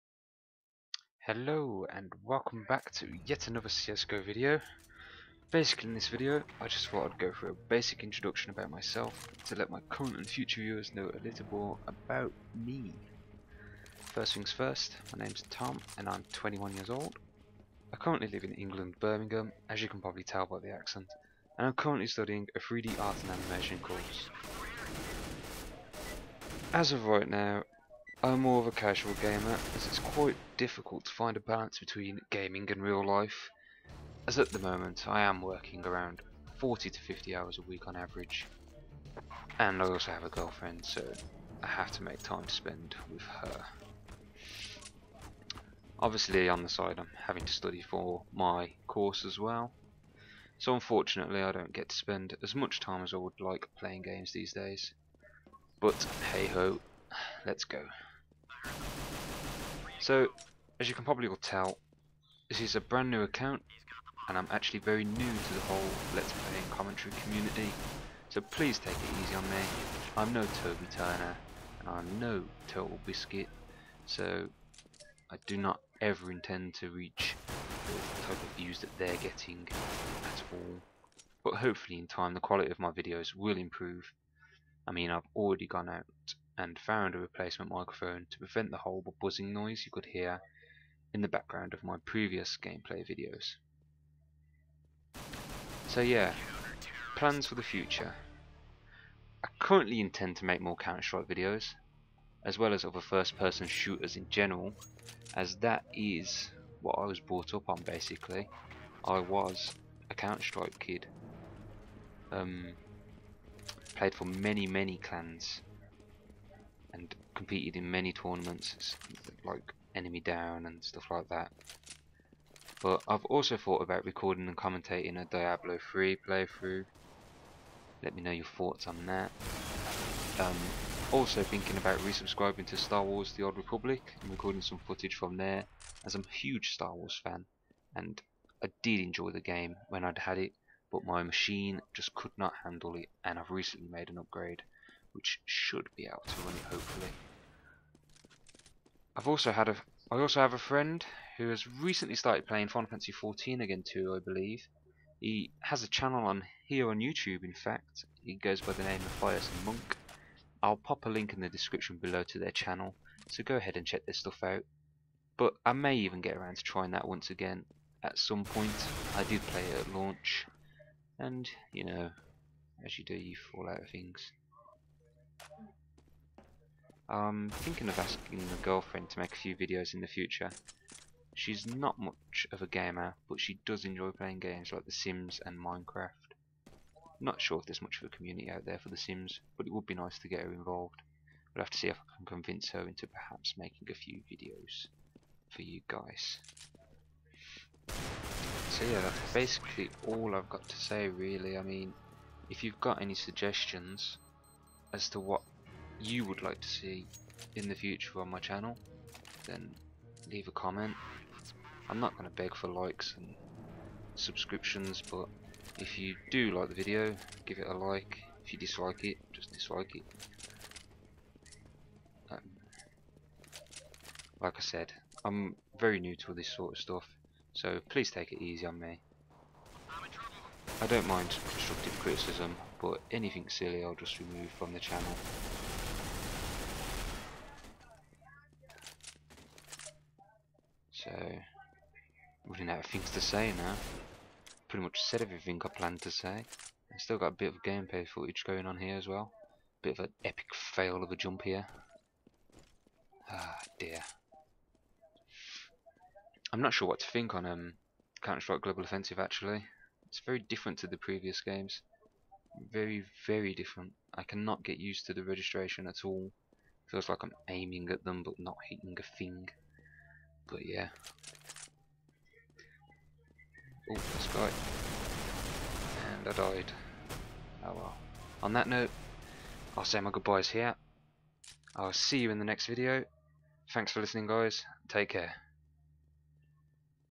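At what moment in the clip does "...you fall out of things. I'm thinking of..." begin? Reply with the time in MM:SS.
02:53.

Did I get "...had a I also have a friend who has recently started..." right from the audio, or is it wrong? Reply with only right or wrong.
right.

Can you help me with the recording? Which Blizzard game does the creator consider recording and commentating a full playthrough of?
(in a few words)
Diablo 3.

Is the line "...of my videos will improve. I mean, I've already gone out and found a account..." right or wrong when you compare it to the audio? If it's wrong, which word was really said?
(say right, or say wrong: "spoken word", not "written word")
wrong: "replacement", not "account".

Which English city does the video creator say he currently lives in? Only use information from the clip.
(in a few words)
Birmingham.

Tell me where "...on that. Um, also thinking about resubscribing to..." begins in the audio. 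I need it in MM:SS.
02:08.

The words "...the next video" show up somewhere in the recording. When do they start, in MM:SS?
04:42.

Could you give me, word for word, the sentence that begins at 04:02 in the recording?
running out of things to say now.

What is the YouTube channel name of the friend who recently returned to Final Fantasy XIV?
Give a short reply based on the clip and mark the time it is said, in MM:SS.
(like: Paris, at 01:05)
Firesome Monk, at 02:39.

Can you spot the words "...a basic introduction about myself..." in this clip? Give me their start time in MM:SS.
00:07.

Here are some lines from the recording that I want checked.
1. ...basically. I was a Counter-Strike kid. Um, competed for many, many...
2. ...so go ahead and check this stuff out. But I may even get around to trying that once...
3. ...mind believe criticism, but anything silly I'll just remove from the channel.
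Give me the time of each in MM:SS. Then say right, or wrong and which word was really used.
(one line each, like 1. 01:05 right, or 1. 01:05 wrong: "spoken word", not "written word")
1. 01:47 wrong: "played", not "competed"
2. 02:43 right
3. 03:51 wrong: "constructive", not "believe".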